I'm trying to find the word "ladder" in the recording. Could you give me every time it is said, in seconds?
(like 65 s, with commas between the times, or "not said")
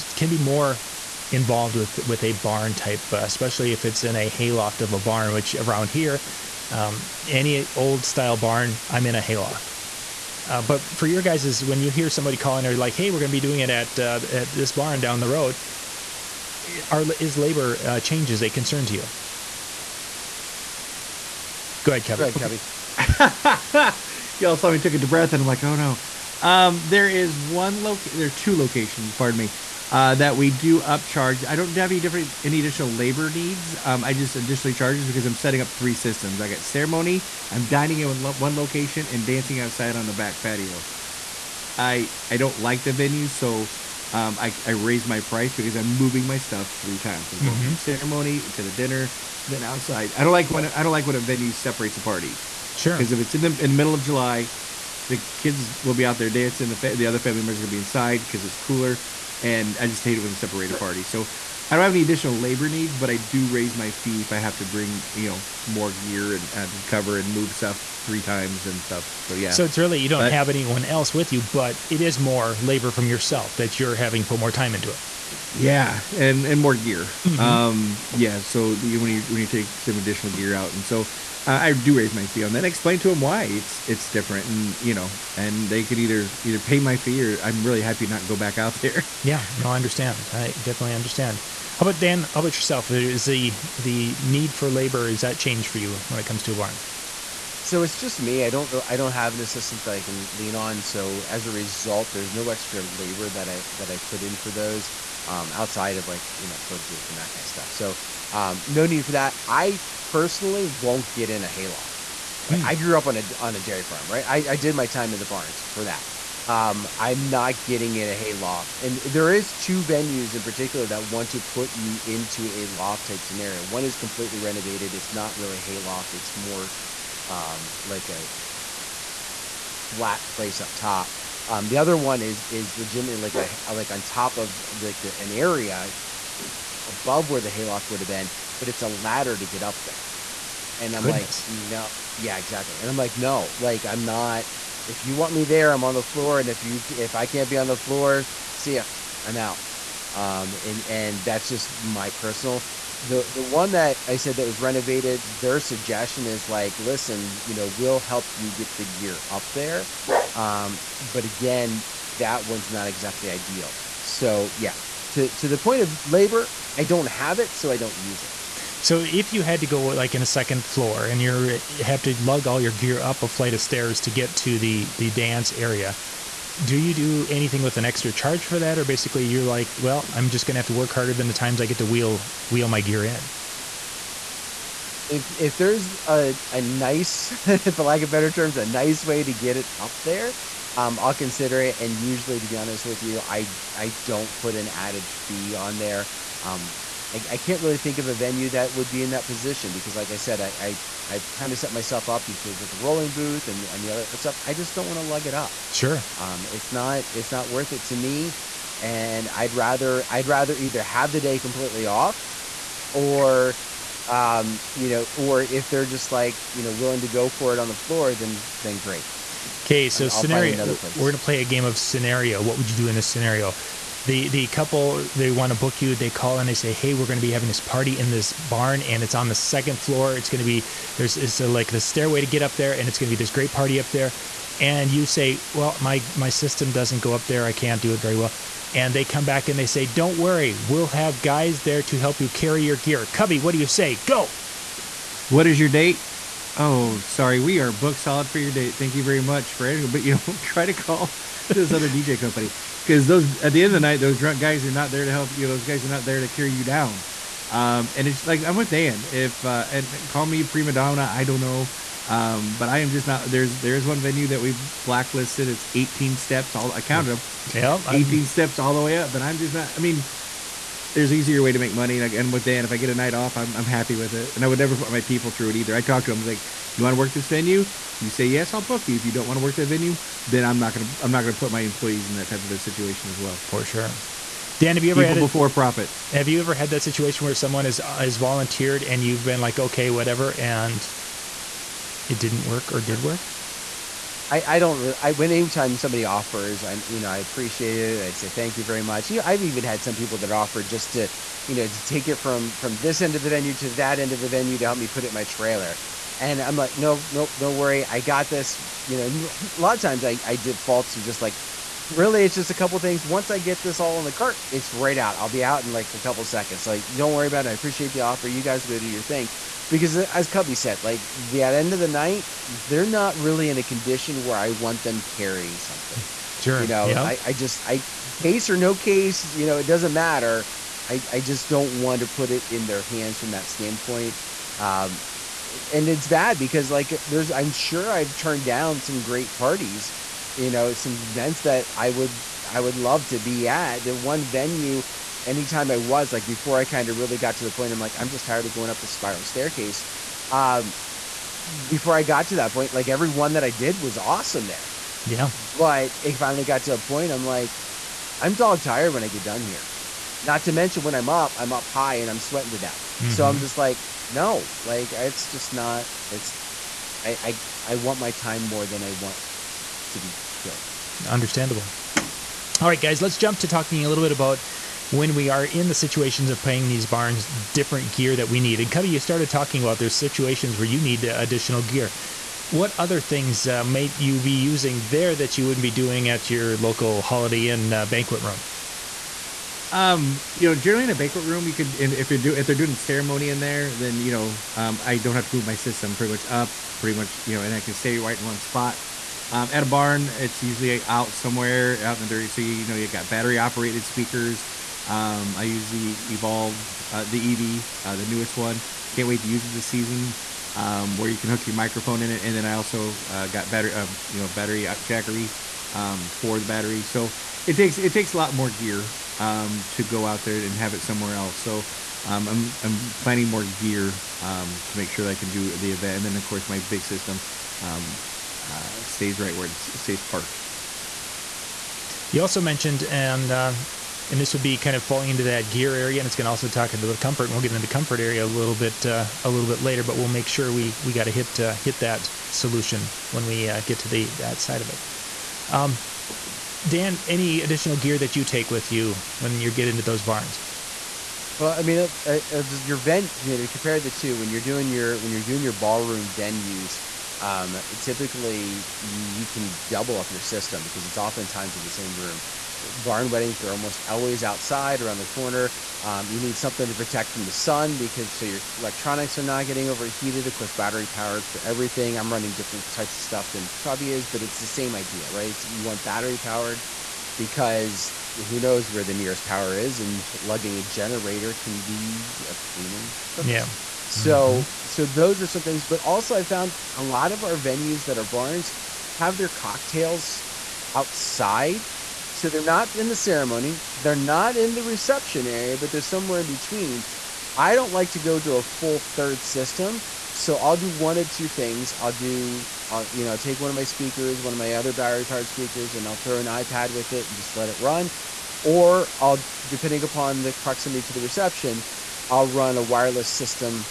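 138 s.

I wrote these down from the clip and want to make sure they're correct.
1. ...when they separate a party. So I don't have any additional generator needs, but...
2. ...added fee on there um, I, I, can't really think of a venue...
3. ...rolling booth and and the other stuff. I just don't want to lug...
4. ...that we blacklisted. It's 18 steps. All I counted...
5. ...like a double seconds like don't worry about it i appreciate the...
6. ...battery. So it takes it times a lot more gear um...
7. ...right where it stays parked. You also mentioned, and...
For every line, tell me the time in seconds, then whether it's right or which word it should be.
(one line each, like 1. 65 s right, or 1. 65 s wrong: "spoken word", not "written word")
1. 60 s wrong: "labor", not "generator"
2. 194 s right
3. 202 s right
4. 264 s right
5. 315 s wrong: "couple", not "double"
6. 416 s wrong: "takes", not "times"
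7. 429 s right.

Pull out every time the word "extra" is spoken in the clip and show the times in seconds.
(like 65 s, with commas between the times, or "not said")
102 s, 177 s.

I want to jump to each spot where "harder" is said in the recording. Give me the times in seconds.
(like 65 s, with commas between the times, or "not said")
180 s.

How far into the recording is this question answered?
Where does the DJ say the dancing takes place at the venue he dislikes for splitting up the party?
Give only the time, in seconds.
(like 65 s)
40 s.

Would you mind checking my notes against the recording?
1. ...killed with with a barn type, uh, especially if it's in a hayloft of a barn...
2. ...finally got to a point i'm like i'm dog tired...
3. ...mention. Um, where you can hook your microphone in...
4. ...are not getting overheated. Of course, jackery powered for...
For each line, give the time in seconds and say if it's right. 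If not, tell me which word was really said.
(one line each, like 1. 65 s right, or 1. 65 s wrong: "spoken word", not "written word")
1. 1 s wrong: "involved", not "killed"
2. 356 s right
3. 409 s wrong: "season", not "mention"
4. 469 s wrong: "battery", not "jackery".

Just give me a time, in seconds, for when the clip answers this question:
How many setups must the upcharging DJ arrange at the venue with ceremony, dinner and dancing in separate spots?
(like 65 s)
35 s.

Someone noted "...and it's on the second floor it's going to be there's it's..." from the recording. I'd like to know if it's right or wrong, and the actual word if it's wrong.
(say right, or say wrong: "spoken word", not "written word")
right.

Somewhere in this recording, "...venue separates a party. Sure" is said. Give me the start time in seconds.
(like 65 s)
51 s.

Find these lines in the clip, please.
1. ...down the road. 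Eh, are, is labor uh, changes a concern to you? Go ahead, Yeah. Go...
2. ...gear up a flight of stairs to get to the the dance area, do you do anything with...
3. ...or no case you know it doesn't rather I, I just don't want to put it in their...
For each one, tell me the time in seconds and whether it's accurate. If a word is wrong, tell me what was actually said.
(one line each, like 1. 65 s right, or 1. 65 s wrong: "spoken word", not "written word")
1. 15 s wrong: "Kevin", not "Yeah"
2. 172 s right
3. 328 s wrong: "matter", not "rather".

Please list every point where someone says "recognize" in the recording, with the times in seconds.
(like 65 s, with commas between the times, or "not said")
not said.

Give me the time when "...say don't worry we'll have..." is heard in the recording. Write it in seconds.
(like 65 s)
239 s.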